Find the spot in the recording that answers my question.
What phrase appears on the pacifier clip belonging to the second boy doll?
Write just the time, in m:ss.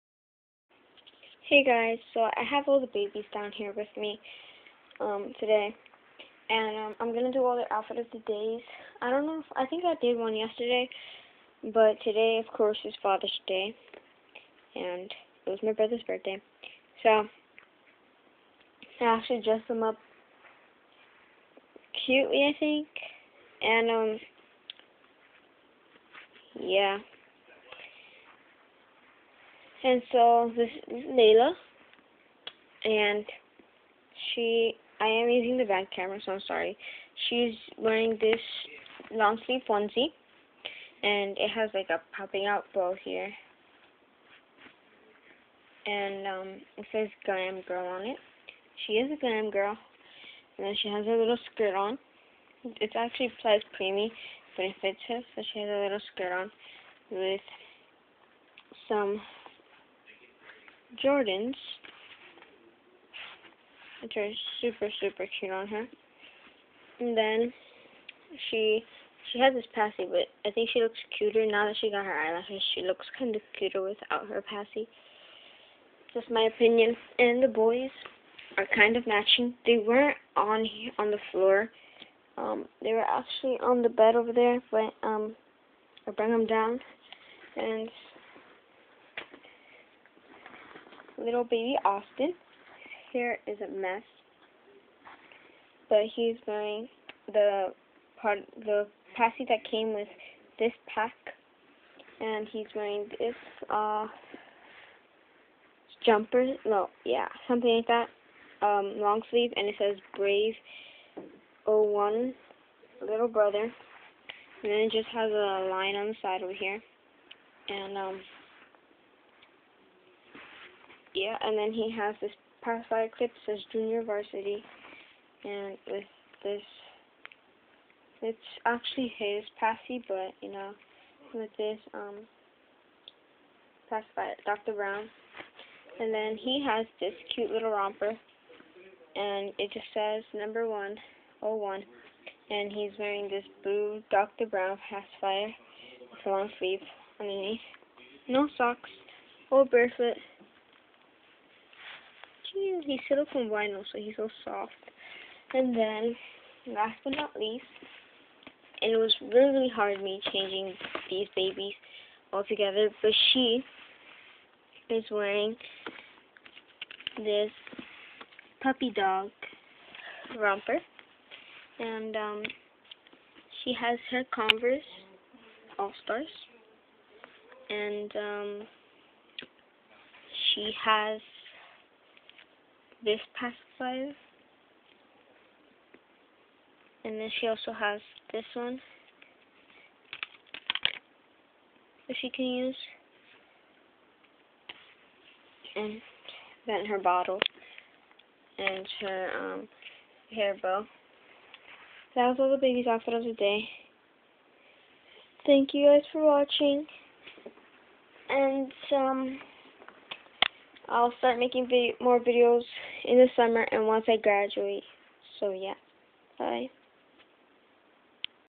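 2:03.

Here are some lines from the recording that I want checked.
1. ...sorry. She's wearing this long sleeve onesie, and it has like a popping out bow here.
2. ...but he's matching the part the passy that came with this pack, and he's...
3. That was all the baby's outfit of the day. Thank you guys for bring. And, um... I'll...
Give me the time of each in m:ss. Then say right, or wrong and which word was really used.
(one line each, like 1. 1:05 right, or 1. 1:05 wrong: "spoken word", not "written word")
1. 0:36 right
2. 1:35 wrong: "wearing", not "matching"
3. 3:22 wrong: "watching", not "bring".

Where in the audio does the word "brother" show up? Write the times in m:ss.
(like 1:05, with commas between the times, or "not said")
0:15, 1:53.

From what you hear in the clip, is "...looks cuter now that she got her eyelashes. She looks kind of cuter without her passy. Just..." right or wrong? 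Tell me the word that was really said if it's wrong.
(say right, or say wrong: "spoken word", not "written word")
right.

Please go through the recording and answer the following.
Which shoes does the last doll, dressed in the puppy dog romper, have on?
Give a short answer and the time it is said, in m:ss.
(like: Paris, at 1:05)
Converse All Stars, at 2:54.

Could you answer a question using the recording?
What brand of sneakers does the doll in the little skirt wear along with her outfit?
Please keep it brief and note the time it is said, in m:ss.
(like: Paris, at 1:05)
Jordans, at 1:01.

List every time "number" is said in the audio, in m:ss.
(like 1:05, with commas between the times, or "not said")
2:20.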